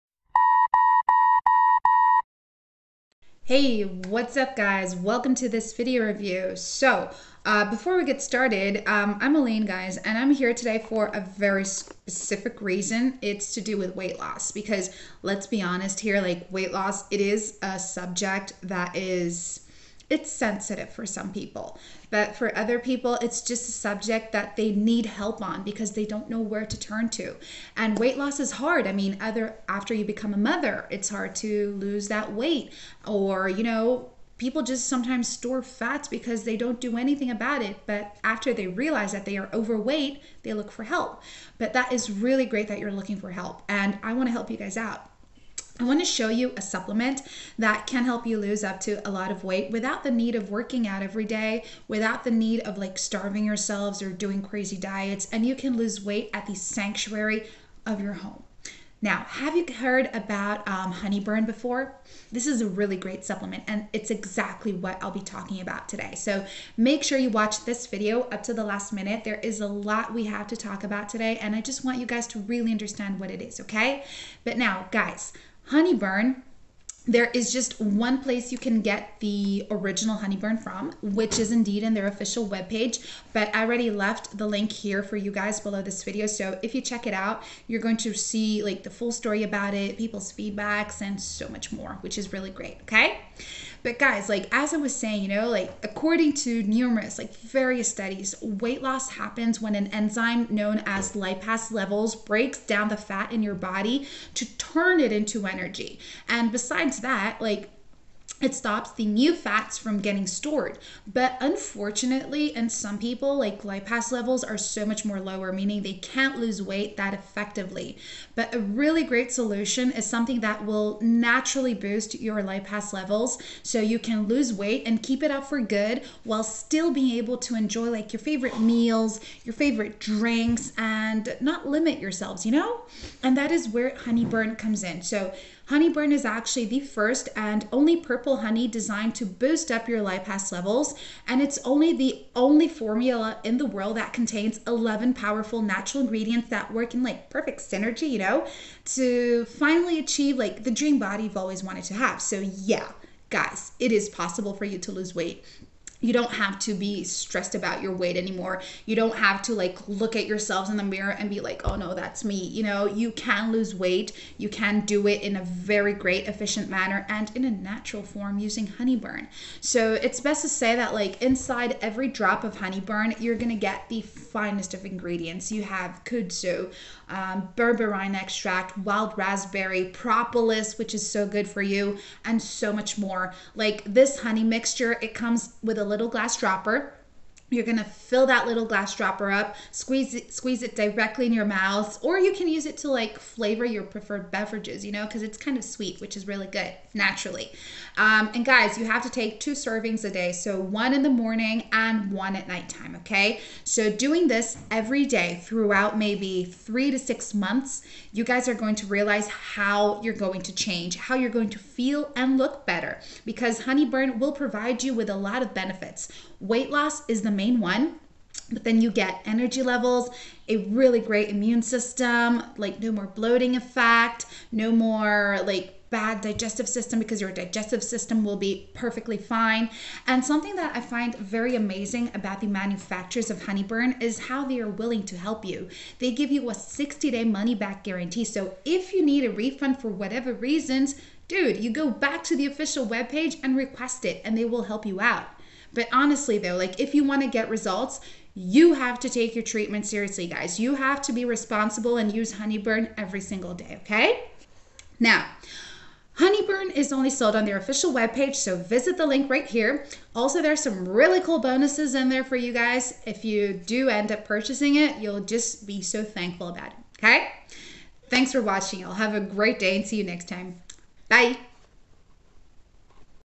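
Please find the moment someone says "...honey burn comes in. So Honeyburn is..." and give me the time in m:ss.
2:13.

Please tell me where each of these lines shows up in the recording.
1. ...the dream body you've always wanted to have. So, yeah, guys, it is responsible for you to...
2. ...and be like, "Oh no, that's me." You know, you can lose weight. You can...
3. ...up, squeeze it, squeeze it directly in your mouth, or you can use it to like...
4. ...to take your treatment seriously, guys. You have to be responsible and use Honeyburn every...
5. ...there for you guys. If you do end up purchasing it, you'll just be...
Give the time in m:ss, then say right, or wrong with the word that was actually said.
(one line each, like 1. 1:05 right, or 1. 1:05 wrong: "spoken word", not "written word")
1. 2:30 wrong: "possible", not "responsible"
2. 2:41 right
3. 3:09 right
4. 4:09 right
5. 4:22 right.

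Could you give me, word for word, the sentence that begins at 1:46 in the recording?
And besides that, like it stops the new fats from getting stored.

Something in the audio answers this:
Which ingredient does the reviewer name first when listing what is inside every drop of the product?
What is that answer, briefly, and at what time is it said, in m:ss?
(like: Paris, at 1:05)
Kudzu, at 2:56.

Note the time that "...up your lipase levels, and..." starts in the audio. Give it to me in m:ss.
2:19.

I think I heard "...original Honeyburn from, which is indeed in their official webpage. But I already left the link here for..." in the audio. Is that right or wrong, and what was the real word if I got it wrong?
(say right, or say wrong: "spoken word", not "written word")
right.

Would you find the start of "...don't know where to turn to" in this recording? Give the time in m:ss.
0:26.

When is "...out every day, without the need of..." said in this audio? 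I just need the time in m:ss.
0:50.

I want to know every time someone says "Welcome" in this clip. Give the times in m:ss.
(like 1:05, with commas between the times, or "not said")
0:04.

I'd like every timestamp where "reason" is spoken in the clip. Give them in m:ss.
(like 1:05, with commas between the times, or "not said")
0:12, 4:00.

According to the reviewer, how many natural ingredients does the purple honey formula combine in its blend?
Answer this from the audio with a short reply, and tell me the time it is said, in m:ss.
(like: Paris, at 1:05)
11, at 2:24.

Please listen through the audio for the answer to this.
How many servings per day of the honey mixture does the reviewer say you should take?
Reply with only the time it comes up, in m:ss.
3:19.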